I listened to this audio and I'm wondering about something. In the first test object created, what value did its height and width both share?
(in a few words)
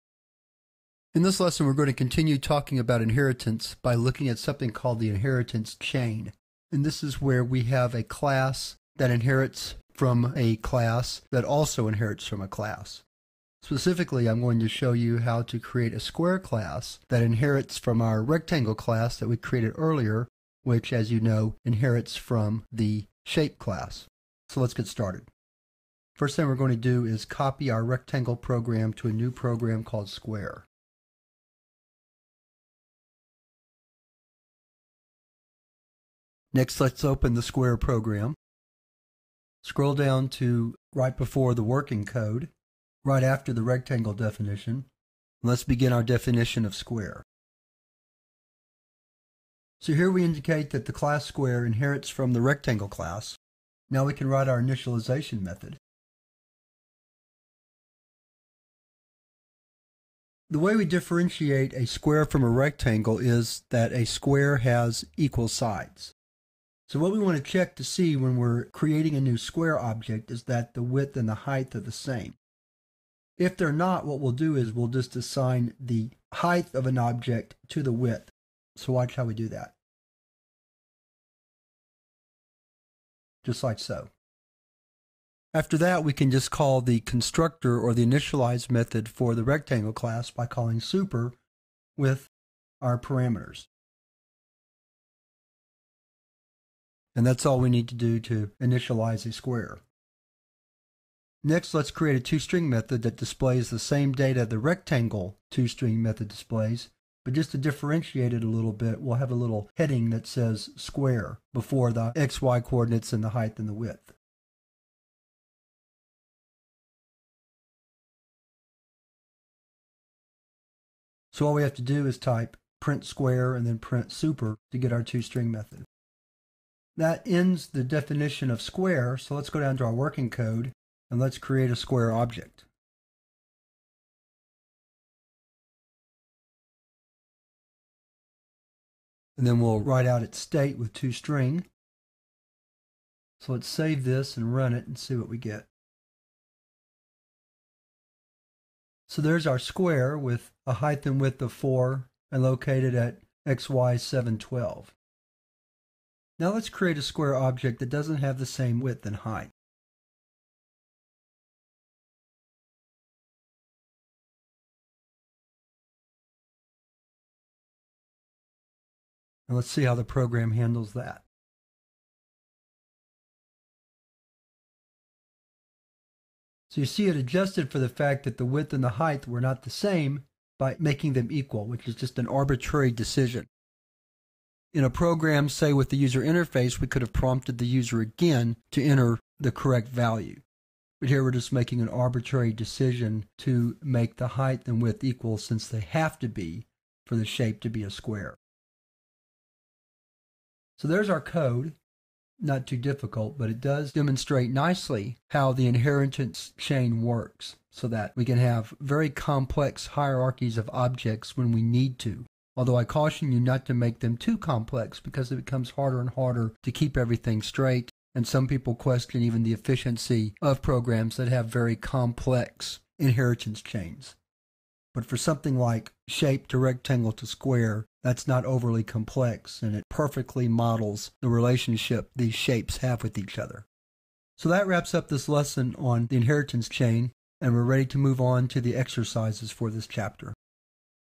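4.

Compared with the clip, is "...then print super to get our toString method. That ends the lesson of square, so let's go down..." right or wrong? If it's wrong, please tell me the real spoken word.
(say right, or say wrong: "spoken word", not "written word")
wrong: "definition", not "lesson".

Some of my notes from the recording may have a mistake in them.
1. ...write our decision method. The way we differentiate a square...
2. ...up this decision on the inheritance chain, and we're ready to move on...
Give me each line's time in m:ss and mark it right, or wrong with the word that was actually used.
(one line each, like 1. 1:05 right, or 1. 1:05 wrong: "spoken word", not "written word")
1. 0:54 wrong: "initialization", not "decision"
2. 3:54 wrong: "lesson", not "decision".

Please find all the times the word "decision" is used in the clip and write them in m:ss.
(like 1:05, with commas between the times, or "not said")
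3:02, 3:12.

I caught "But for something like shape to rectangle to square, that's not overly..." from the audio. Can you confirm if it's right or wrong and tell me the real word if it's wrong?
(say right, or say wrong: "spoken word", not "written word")
right.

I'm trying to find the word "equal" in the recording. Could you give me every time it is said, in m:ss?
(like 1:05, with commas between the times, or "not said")
1:05, 3:01, 3:15.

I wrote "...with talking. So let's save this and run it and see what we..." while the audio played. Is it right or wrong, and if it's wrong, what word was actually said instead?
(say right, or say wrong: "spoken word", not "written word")
wrong: "toString", not "talking".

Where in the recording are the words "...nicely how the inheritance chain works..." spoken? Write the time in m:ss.
3:24.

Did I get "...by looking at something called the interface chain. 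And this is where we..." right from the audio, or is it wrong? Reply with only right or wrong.
wrong.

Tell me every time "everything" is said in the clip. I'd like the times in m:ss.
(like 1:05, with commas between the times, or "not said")
3:36.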